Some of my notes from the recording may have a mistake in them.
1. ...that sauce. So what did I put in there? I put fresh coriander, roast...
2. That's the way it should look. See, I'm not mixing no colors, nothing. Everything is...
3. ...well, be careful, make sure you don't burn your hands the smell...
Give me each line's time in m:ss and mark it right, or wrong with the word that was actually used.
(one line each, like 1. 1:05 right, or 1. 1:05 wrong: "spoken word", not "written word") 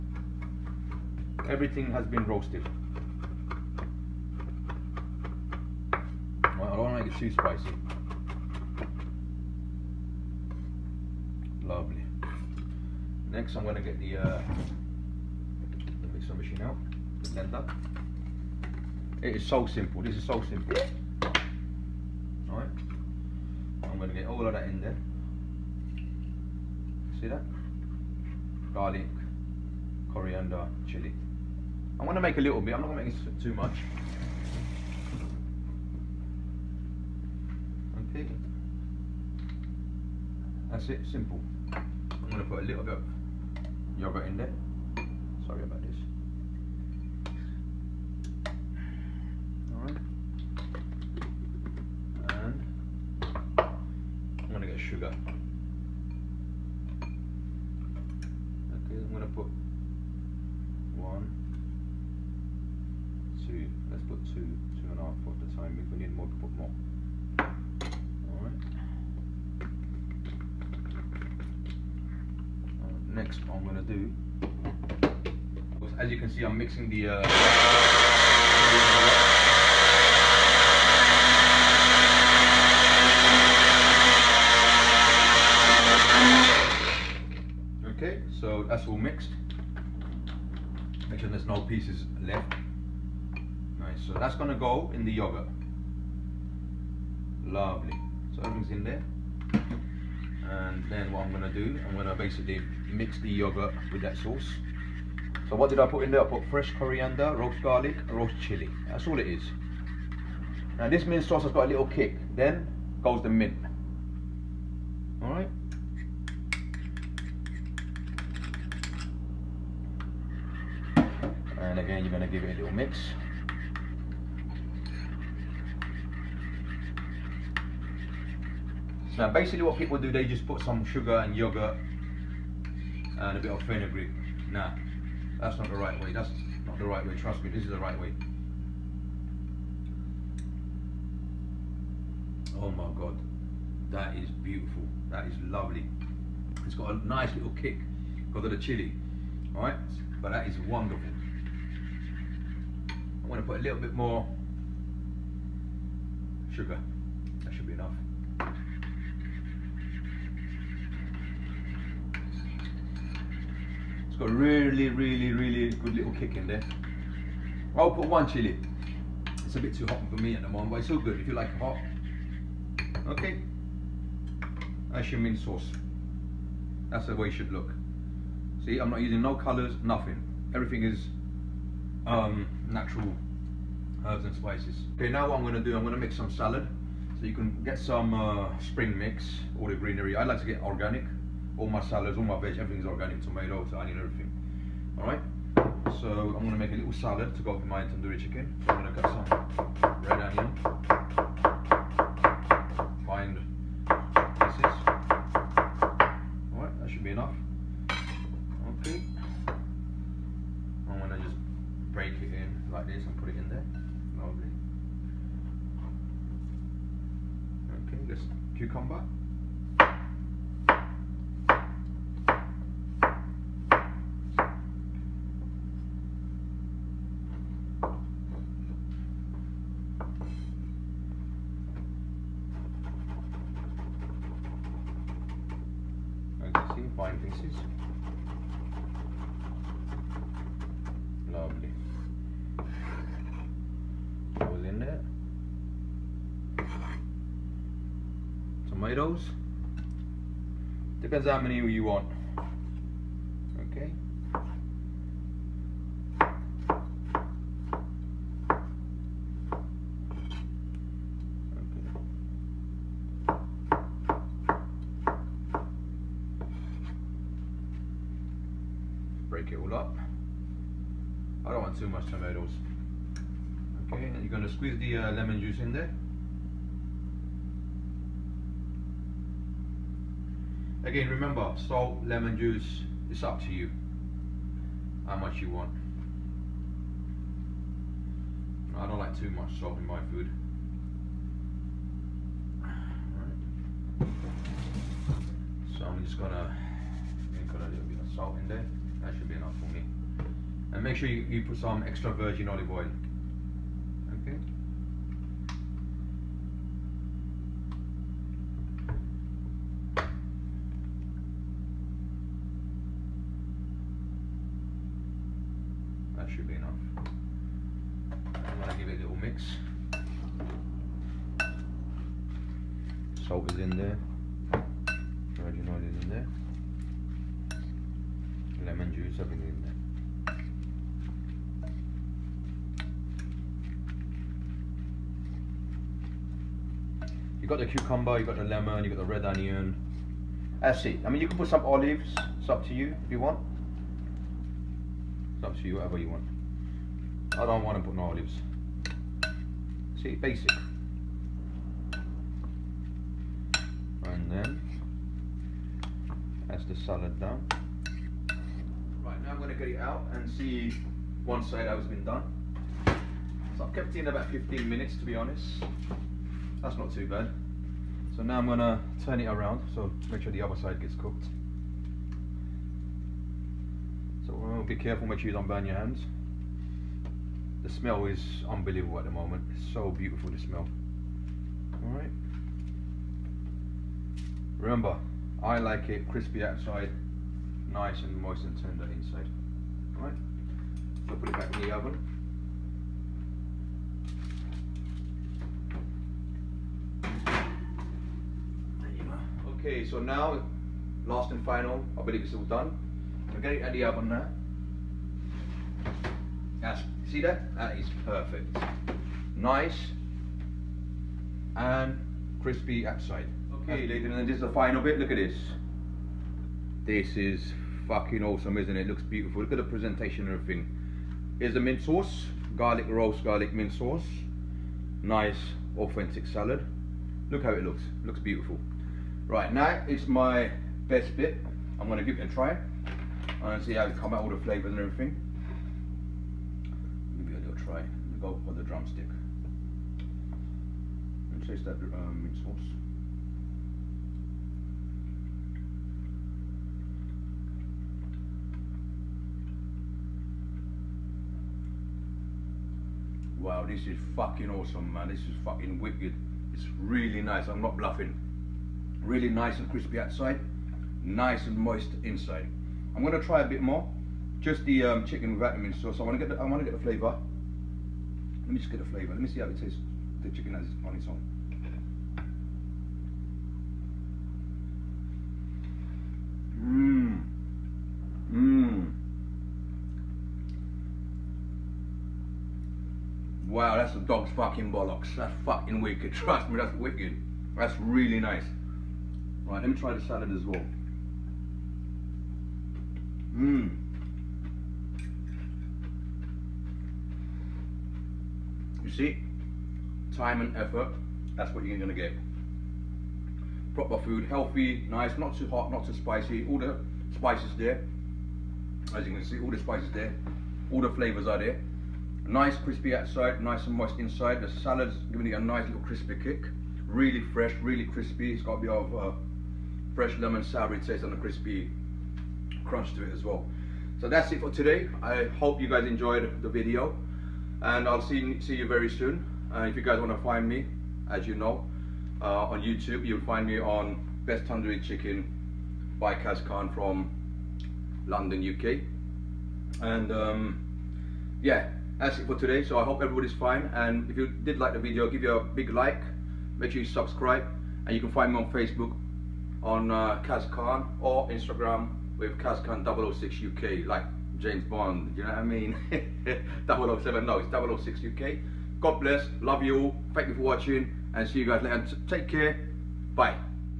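1. 1:44 right
2. 2:56 wrong: "using", not "mixing"
3. 6:14 right.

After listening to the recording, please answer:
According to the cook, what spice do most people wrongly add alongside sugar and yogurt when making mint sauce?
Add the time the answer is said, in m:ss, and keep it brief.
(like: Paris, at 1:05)
fenugreek, at 2:13.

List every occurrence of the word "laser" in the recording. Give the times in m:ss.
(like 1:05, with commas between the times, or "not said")
not said.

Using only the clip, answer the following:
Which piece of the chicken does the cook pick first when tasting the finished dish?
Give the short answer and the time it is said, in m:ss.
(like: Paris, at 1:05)
drumstick, at 7:18.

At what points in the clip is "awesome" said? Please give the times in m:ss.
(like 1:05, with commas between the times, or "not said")
6:58, 7:34.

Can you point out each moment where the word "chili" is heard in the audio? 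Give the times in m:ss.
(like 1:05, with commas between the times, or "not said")
0:30, 1:48, 2:28, 2:48.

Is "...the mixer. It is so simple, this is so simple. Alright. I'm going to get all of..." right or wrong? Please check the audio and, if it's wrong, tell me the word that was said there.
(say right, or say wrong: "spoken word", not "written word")
wrong: "blender", not "mixer".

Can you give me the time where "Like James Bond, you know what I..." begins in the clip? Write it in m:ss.
9:13.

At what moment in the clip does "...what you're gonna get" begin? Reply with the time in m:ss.
8:21.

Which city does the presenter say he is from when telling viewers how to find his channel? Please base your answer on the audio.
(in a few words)
London.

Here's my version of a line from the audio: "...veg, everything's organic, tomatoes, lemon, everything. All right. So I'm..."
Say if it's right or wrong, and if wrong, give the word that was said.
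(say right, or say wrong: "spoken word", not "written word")
wrong: "onion", not "lemon".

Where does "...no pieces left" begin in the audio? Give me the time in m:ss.
1:31.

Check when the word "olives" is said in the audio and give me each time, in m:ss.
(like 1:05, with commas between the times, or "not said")
5:02, 5:41, 5:48.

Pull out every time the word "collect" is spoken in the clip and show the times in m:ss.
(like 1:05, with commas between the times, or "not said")
not said.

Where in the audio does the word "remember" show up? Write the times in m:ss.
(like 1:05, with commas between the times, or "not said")
4:41, 6:24.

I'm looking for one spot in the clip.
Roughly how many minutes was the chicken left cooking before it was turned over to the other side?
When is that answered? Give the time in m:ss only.
6:04.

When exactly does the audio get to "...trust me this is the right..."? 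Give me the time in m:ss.
2:17.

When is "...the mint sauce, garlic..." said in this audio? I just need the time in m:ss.
7:01.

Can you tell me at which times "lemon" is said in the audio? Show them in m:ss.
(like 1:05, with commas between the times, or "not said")
4:35, 4:42, 5:28, 5:38, 8:40.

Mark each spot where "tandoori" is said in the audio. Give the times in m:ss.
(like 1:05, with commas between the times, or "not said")
3:17, 8:54.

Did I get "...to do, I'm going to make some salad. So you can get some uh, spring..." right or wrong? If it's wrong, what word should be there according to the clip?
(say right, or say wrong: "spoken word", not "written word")
right.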